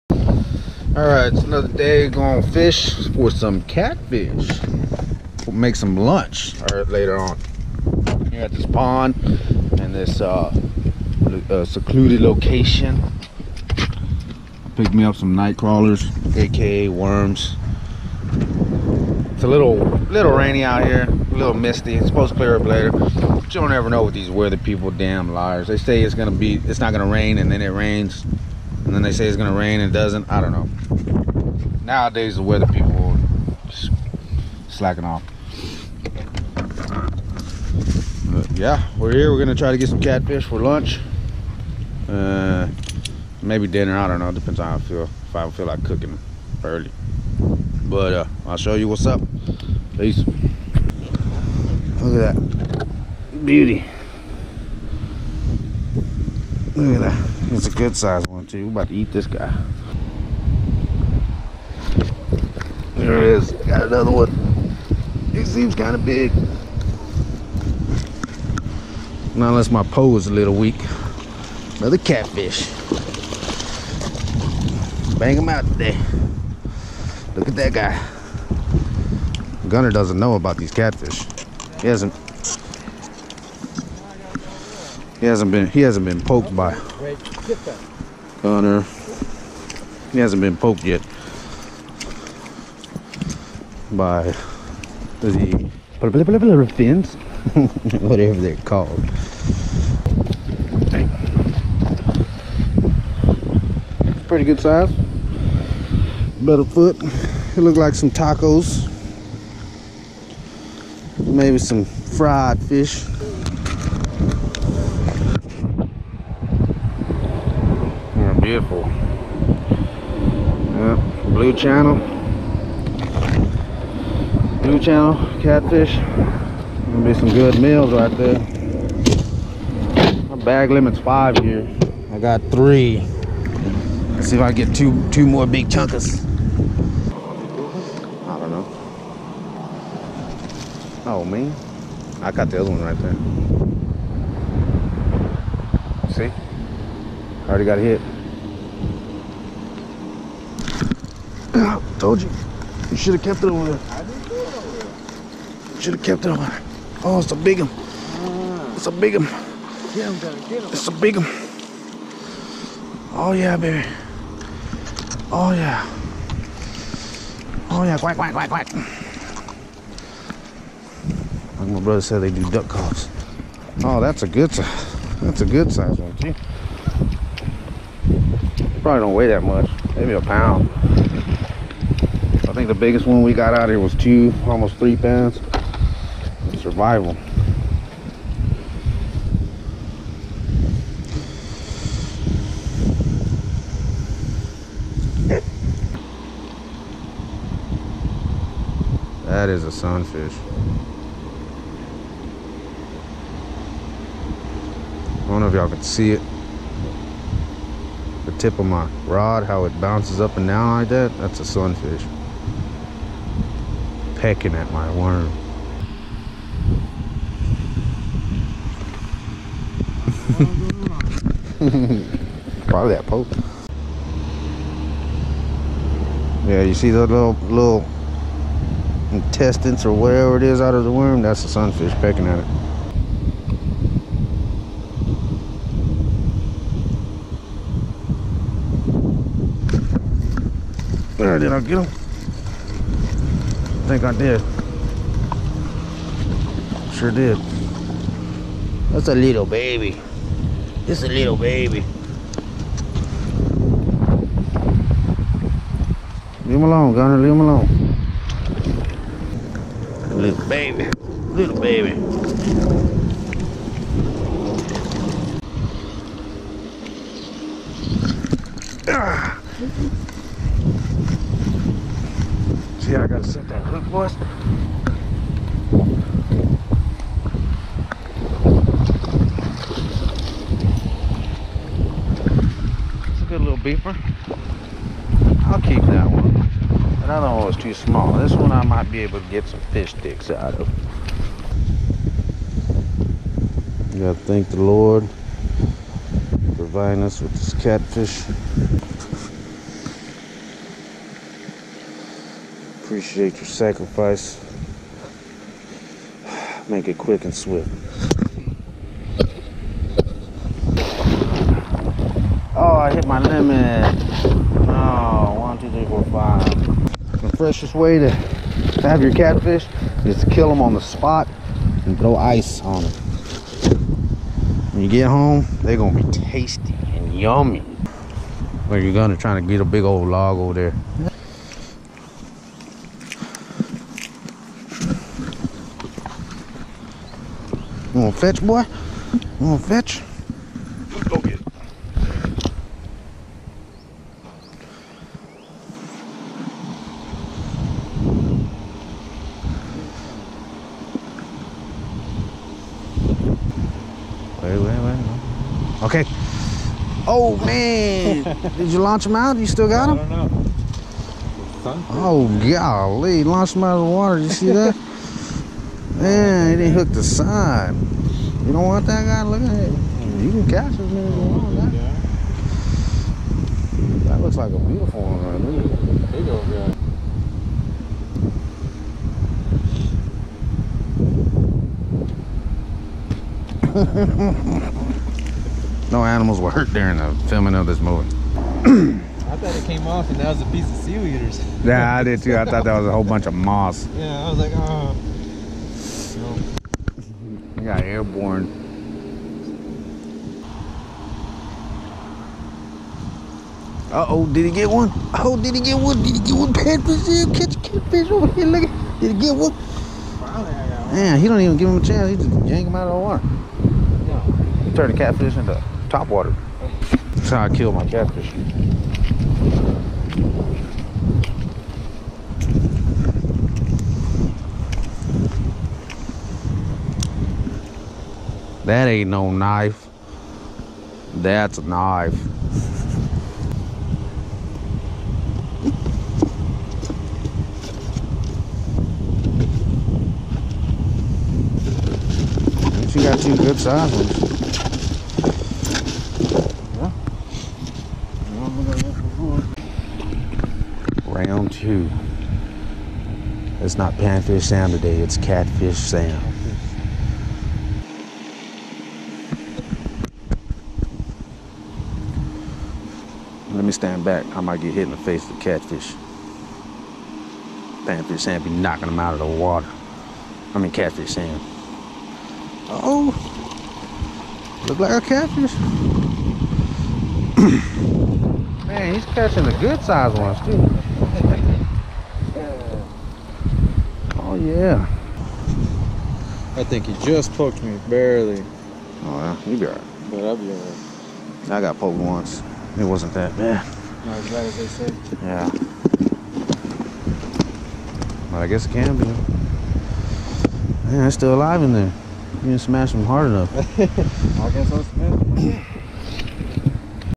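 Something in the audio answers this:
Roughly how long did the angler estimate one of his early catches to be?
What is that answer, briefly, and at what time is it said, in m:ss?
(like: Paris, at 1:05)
About a foot, at 1:46.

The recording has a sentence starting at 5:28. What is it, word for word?
Where you gonna try to get a big old log over there.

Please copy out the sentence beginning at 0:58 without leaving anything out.
We're about to eat this guy.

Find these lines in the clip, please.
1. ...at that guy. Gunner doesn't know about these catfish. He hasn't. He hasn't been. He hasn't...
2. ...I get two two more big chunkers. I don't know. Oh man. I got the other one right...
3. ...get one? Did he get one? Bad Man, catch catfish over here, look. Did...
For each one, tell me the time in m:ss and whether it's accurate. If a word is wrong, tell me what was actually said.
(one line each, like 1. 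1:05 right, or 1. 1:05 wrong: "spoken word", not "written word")
1. 1:17 right
2. 2:14 right
3. 6:45 wrong: "Brazil", not "Man".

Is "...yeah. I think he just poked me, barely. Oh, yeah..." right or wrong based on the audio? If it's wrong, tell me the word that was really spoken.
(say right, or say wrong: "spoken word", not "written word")
right.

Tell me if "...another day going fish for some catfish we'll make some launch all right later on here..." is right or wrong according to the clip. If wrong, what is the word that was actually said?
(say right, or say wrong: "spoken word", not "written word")
wrong: "lunch", not "launch".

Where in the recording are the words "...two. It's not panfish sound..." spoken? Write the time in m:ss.
7:31.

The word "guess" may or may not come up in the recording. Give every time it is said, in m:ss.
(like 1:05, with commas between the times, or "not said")
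8:18, 8:24.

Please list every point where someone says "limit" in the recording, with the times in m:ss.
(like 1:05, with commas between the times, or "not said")
2:10, 5:13.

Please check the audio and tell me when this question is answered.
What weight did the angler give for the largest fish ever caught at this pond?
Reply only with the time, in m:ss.
3:04.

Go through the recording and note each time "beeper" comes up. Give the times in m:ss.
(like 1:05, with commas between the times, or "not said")
4:43.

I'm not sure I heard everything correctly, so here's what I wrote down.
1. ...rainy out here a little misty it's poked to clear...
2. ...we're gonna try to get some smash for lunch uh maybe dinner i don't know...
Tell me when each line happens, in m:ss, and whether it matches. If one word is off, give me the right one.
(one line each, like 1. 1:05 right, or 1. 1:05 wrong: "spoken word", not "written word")
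1. 0:20 wrong: "supposed", not "poked"
2. 0:39 wrong: "catfish", not "smash".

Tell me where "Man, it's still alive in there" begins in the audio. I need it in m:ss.
8:20.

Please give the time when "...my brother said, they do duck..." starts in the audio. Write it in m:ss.
2:51.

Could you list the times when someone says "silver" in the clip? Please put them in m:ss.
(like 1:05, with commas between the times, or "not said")
not said.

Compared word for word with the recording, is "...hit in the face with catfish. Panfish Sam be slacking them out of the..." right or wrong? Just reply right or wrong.
wrong.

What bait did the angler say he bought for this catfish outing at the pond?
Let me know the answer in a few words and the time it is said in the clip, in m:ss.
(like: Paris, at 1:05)
Night crawlers, at 0:15.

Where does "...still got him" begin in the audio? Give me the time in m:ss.
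5:59.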